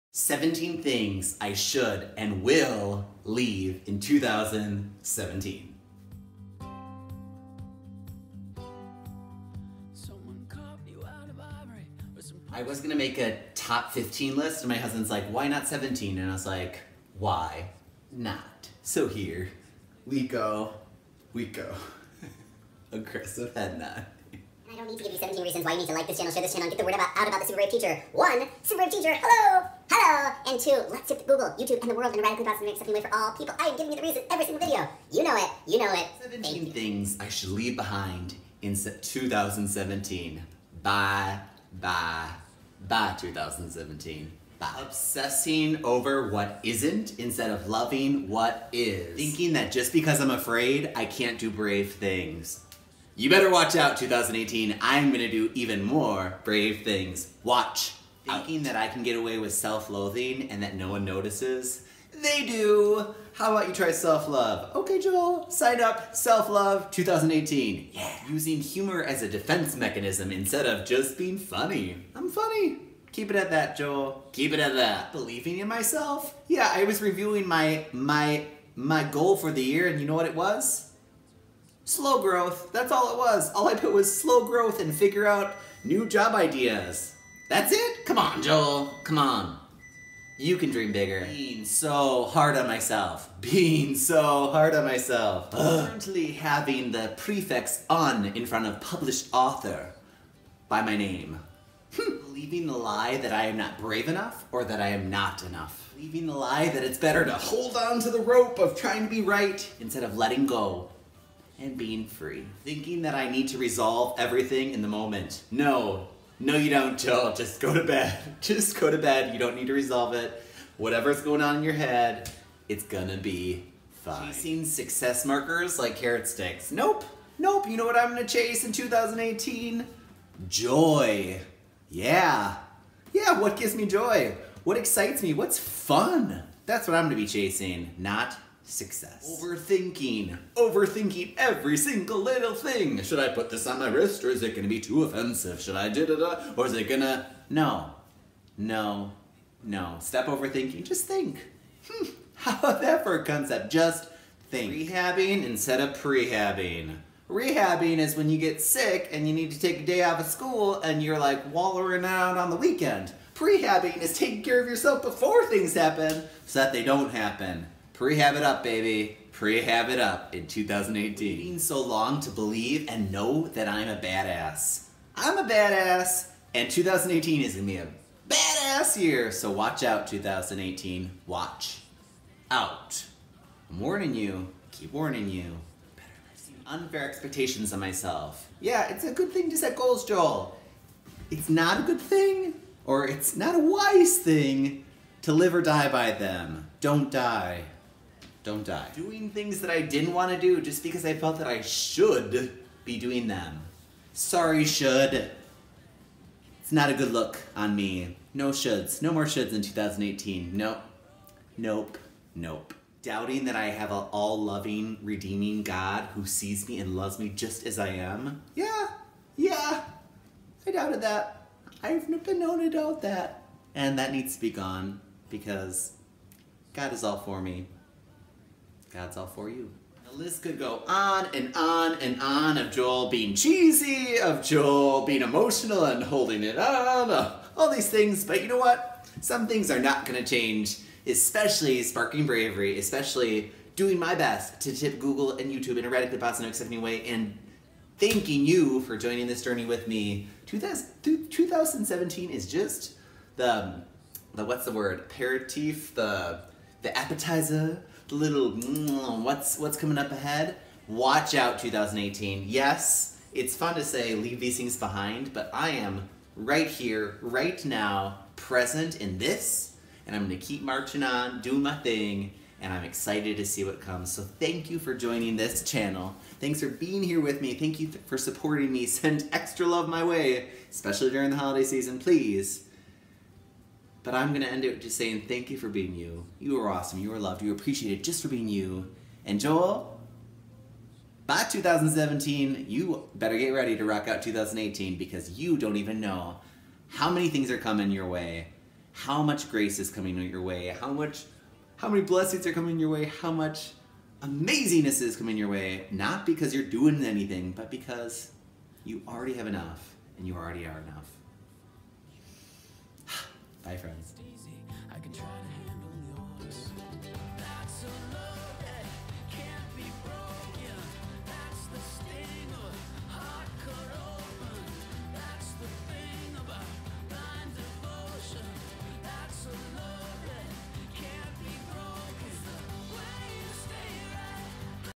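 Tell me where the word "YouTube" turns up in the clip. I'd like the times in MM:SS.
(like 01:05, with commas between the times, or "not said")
00:31, 04:05.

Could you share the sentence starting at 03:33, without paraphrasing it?
Doubting that I have an all loving, redeeming God who sees me and loves me just as I am.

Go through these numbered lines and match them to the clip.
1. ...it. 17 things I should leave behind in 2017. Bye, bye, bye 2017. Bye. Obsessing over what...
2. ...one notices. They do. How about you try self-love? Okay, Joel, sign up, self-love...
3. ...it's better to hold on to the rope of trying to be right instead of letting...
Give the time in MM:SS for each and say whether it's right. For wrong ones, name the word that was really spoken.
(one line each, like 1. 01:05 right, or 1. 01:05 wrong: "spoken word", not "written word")
1. 00:35 right
2. 01:00 right
3. 01:46 right.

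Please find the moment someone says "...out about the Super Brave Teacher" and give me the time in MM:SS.
00:27.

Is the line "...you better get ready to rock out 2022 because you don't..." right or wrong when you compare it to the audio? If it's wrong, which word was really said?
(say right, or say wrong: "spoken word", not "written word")
wrong: "2018", not "2022".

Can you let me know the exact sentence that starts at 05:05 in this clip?
Not because you're doing anything, but because you already have enough and you already are enough.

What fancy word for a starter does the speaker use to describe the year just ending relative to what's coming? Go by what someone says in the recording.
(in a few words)
aperitif.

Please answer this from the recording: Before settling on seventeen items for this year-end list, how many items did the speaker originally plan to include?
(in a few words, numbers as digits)
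15.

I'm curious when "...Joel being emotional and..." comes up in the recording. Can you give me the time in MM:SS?
03:54.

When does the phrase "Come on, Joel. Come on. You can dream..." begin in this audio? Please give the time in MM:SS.
01:28.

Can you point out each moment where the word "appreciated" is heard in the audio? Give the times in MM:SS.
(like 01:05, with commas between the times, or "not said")
04:47.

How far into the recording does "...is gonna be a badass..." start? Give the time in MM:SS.
02:57.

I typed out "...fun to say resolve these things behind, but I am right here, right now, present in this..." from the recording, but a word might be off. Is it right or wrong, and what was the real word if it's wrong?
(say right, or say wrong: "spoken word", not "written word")
wrong: "leave", not "resolve".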